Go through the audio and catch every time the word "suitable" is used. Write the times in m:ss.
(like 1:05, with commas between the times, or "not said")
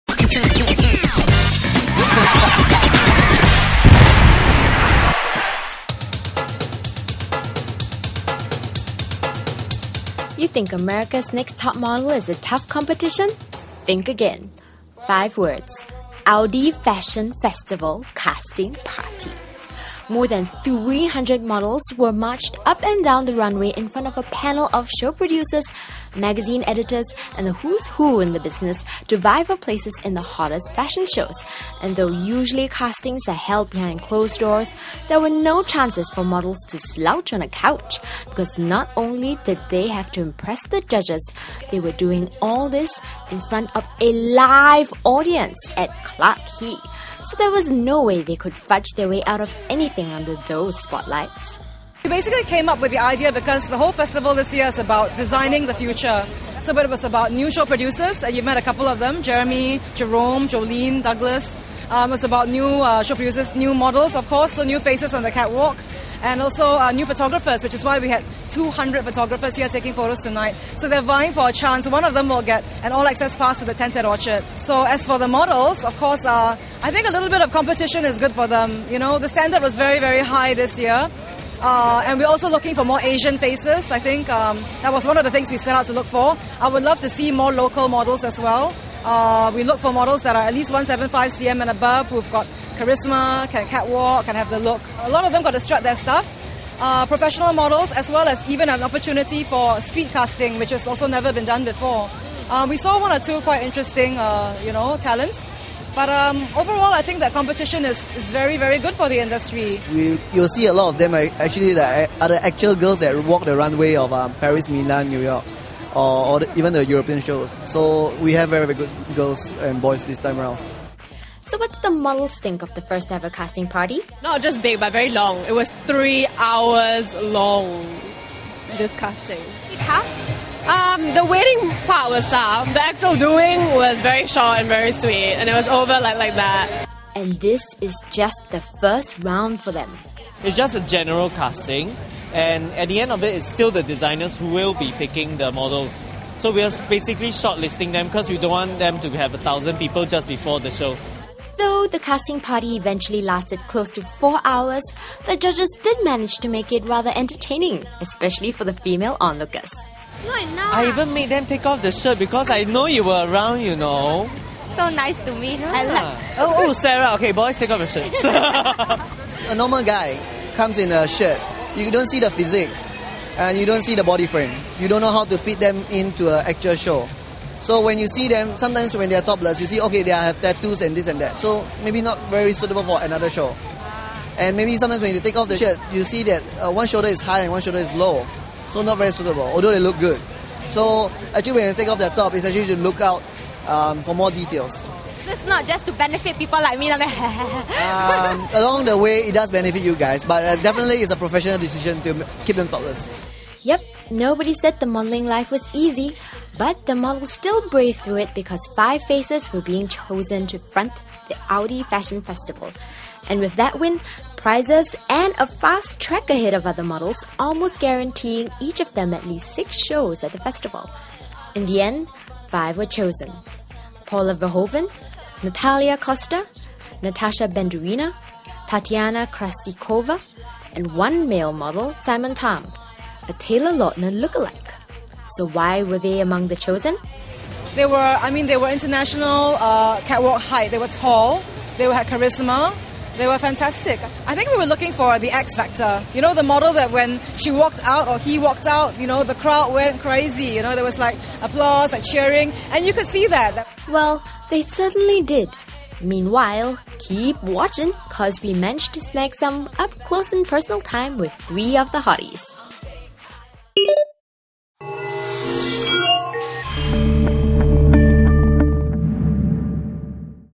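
3:02, 3:09.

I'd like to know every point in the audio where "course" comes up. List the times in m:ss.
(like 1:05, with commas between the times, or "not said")
1:04, 1:15.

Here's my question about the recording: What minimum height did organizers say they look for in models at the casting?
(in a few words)
175 cm.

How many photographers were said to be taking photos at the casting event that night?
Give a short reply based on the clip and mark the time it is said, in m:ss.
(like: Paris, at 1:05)
200, at 1:08.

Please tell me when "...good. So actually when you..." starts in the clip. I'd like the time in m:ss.
3:09.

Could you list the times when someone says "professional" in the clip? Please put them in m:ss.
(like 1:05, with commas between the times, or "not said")
1:37, 3:21.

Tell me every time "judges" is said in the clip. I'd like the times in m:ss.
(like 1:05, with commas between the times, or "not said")
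0:40, 2:35.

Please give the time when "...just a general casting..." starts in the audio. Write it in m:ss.
2:20.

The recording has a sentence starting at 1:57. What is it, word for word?
So we have very, very good girls and boys this time around.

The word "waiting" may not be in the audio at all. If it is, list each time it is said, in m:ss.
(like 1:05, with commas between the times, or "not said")
2:11.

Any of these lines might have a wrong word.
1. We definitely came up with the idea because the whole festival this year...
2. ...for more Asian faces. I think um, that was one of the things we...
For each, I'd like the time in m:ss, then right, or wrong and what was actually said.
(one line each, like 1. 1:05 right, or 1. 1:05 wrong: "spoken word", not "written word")
1. 0:52 wrong: "basically", not "definitely"
2. 1:22 right.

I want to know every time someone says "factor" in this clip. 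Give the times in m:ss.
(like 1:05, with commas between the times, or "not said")
4:05.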